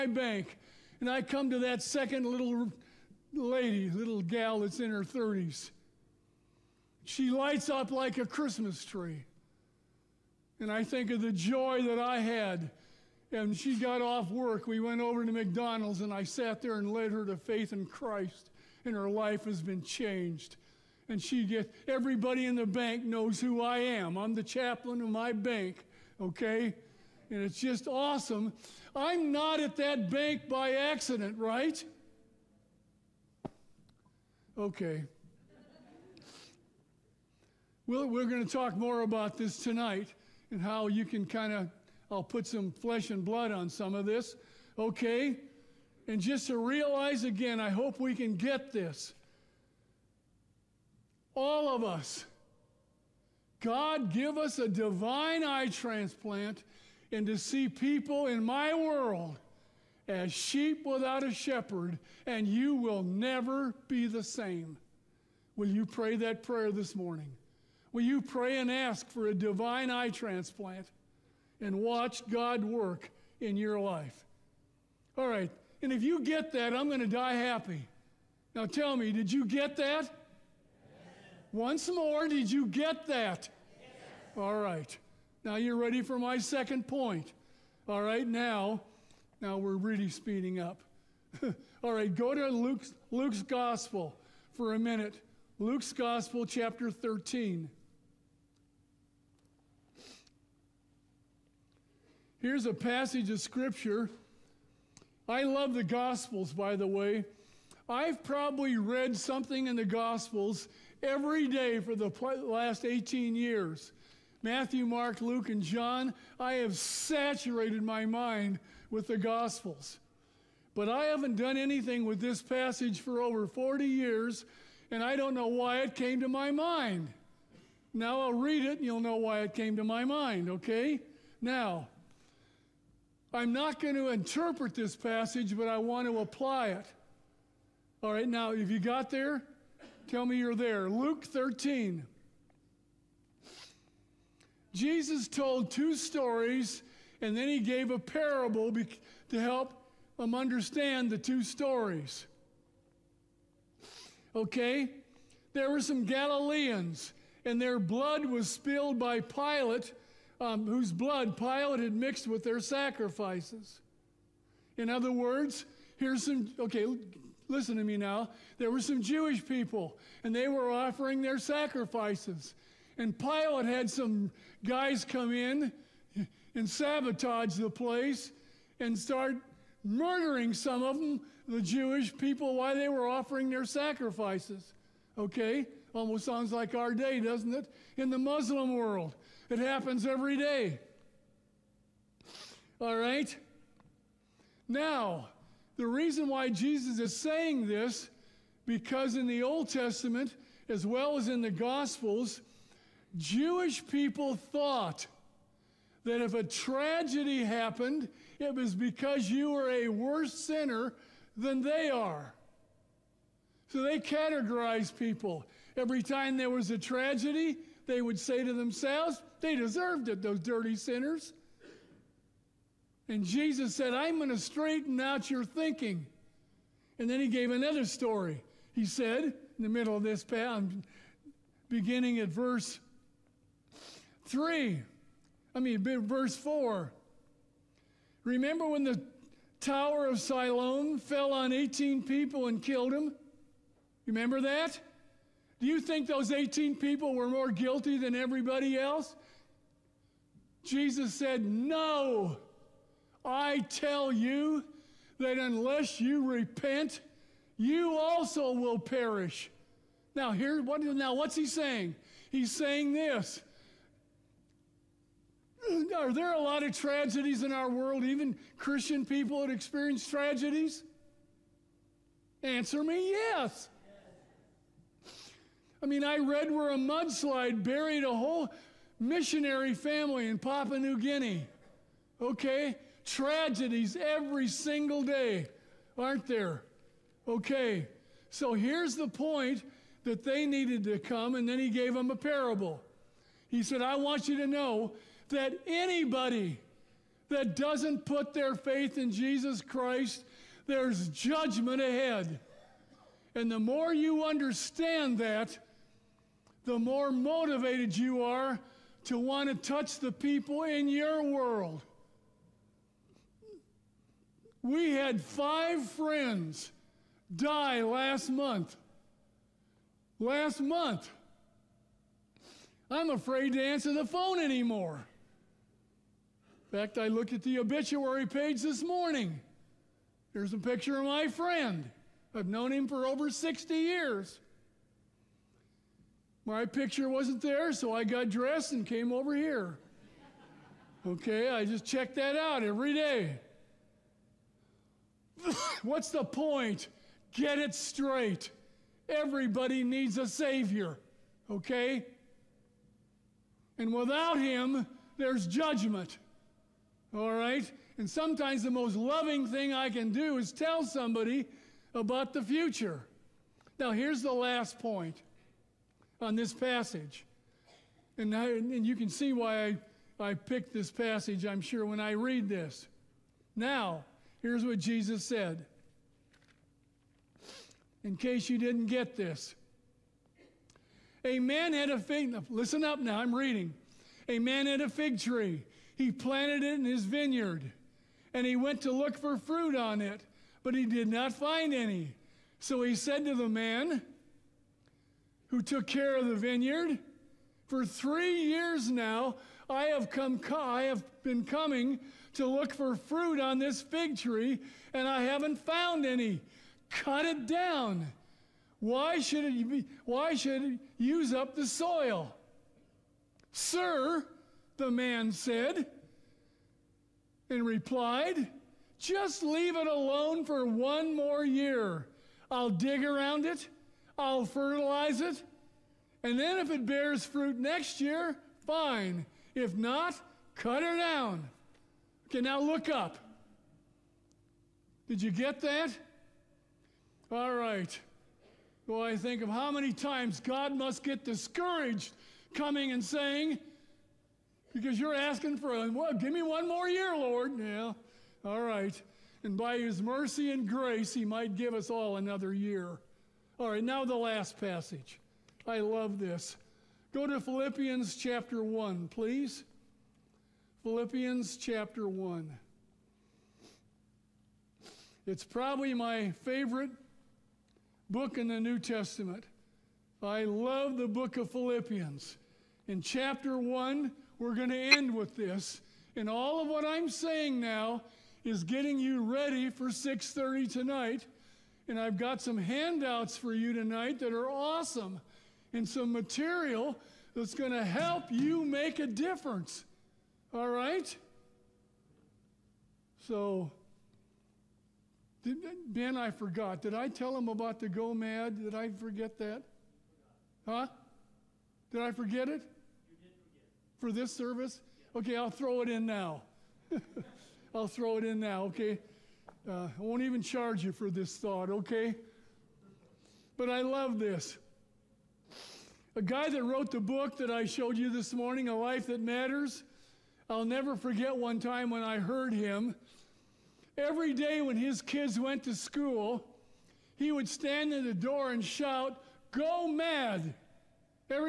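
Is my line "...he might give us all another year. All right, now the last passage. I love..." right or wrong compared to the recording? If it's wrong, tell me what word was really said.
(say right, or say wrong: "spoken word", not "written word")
right.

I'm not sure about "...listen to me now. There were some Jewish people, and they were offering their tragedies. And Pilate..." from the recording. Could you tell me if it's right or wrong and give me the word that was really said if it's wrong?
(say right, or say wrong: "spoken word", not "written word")
wrong: "sacrifices", not "tragedies".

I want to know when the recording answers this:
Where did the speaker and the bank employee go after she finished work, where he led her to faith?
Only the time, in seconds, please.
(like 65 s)
15 s.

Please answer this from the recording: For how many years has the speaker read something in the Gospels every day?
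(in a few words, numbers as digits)
18.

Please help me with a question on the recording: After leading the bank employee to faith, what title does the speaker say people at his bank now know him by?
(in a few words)
Chaplain.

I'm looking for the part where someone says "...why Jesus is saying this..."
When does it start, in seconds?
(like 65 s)
196 s.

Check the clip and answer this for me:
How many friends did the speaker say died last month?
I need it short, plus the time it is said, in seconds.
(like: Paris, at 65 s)
5, at 315 s.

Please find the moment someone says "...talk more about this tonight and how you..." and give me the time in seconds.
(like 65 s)
38 s.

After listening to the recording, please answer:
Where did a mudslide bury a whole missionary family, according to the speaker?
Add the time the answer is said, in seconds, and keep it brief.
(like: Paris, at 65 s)
Papua New Guinea, at 280 s.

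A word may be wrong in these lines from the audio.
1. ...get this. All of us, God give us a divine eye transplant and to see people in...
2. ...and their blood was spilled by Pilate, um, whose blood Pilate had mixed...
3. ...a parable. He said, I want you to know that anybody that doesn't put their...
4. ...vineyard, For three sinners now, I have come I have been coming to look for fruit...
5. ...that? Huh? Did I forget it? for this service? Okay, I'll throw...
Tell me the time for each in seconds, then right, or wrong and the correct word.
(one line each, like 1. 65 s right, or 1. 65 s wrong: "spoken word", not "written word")
1. 48 s right
2. 157 s right
3. 292 s right
4. 396 s wrong: "years", not "sinners"
5. 499 s right.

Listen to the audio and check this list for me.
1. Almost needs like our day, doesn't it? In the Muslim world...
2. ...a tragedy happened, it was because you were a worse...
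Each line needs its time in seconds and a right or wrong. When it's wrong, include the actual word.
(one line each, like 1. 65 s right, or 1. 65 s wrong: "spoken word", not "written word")
1. 185 s wrong: "sounds", not "needs"
2. 206 s right.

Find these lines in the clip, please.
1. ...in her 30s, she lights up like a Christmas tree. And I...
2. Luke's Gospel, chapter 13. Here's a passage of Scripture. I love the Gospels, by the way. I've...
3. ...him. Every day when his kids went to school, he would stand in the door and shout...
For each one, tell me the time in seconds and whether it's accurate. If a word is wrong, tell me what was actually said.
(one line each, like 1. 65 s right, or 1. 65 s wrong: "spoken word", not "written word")
1. 4 s right
2. 95 s right
3. 522 s right.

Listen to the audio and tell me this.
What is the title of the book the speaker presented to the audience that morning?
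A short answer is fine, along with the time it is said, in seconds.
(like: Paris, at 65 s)
A Life That Matters, at 518 s.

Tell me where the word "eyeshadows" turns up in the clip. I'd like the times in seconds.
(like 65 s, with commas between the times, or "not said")
not said.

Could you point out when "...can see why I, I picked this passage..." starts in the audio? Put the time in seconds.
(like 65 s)
368 s.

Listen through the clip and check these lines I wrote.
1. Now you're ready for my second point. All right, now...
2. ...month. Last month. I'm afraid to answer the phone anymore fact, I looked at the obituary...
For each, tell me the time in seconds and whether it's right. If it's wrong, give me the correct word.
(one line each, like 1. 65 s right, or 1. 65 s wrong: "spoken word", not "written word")
1. 85 s right
2. 318 s right.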